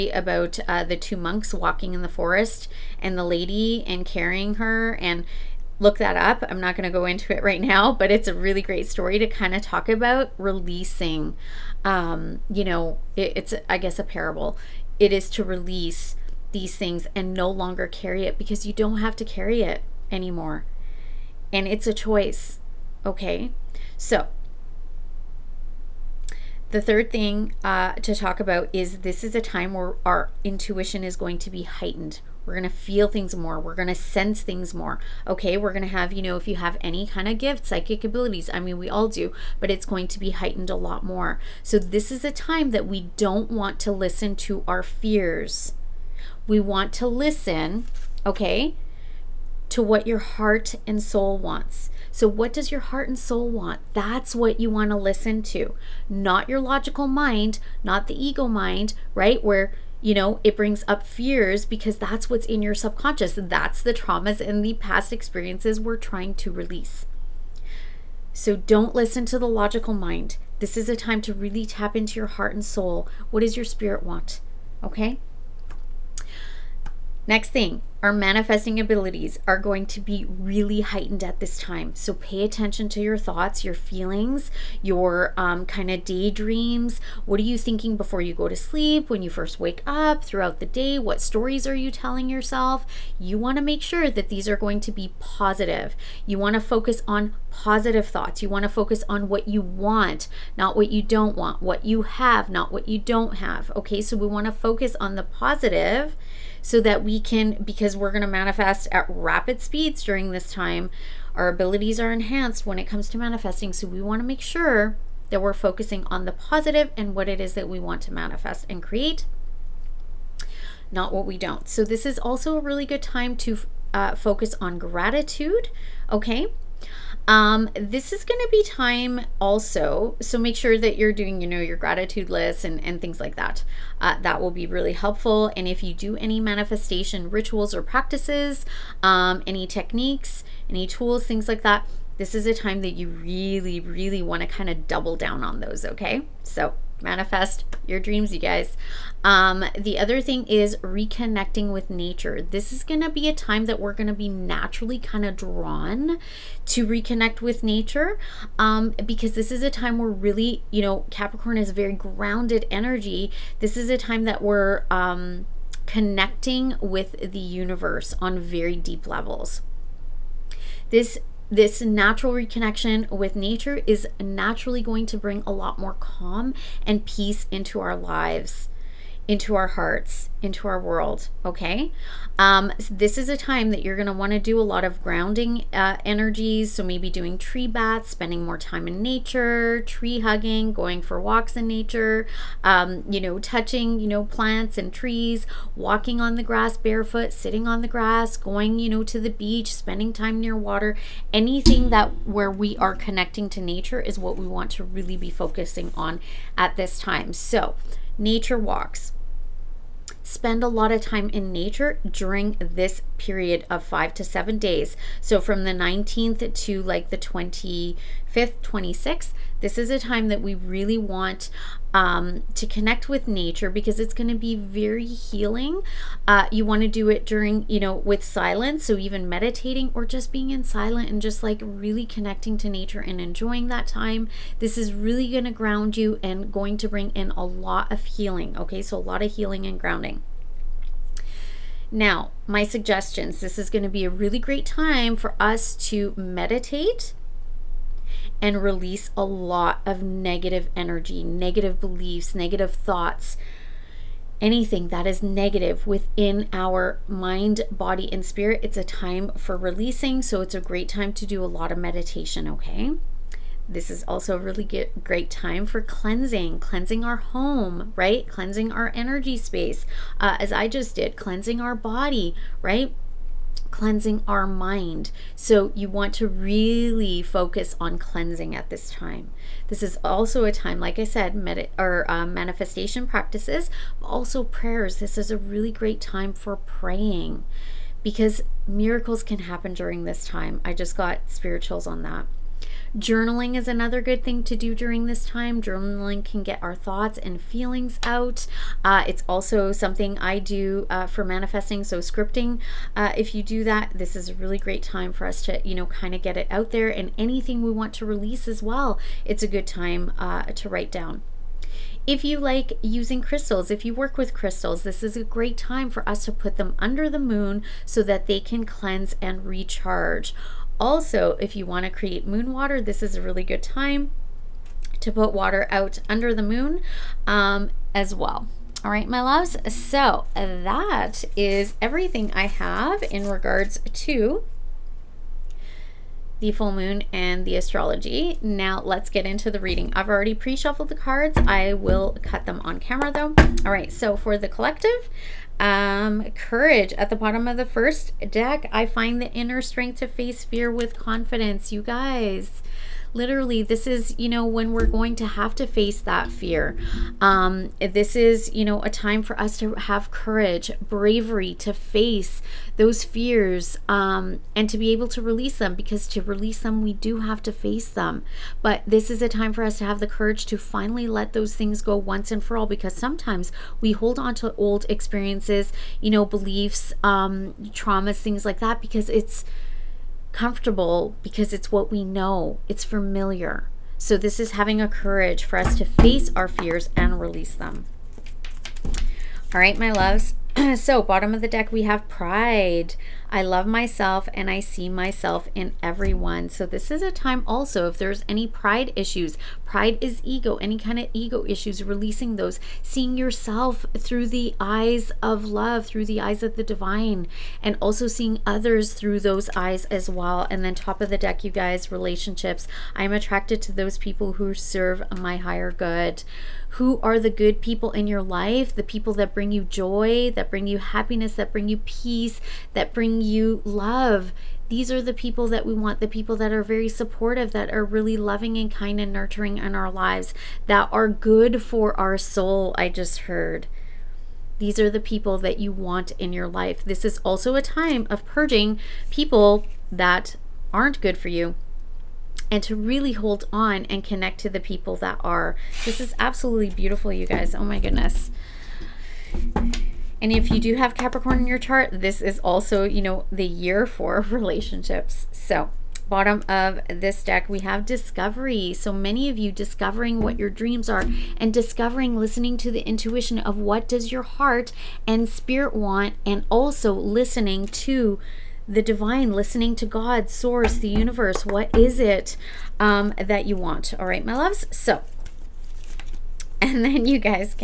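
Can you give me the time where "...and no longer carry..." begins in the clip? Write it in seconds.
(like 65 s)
17 s.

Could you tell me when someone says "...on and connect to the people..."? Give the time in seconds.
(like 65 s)
443 s.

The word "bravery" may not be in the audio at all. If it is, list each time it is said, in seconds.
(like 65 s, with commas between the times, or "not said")
360 s.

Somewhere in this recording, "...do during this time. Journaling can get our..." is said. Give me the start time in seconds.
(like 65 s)
294 s.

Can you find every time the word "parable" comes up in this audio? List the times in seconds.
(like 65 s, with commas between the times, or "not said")
14 s.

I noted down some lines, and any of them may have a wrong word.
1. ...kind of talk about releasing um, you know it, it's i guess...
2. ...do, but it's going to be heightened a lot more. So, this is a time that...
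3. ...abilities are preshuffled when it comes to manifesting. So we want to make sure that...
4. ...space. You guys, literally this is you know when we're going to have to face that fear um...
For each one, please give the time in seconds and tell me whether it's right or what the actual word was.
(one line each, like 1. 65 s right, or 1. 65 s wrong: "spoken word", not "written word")
1. 9 s right
2. 39 s right
3. 111 s wrong: "enhanced", not "preshuffled"
4. 350 s wrong: "confidence", not "space".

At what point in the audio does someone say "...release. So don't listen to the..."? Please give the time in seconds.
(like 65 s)
66 s.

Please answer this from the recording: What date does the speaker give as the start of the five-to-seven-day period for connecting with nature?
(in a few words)
19th.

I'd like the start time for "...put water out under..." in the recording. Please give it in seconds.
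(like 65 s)
325 s.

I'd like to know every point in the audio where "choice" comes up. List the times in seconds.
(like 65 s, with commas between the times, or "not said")
21 s.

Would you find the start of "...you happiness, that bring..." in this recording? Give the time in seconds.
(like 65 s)
420 s.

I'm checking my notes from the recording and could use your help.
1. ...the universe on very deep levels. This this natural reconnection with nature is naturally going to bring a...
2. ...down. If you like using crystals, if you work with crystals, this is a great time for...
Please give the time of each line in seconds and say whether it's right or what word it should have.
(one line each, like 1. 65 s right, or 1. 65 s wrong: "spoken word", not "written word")
1. 167 s right
2. 310 s right.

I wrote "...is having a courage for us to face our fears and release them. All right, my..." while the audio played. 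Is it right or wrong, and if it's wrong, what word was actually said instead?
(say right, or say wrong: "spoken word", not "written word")
right.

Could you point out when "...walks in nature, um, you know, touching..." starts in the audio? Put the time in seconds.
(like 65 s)
191 s.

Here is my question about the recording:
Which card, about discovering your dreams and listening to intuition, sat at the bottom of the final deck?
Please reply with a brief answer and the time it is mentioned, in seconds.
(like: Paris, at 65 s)
Discovery, at 457 s.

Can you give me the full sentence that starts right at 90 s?
What stories are you telling yourself?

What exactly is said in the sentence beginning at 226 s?
Uh, you want to do it during, you know, with silence.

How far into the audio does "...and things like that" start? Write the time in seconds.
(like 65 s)
132 s.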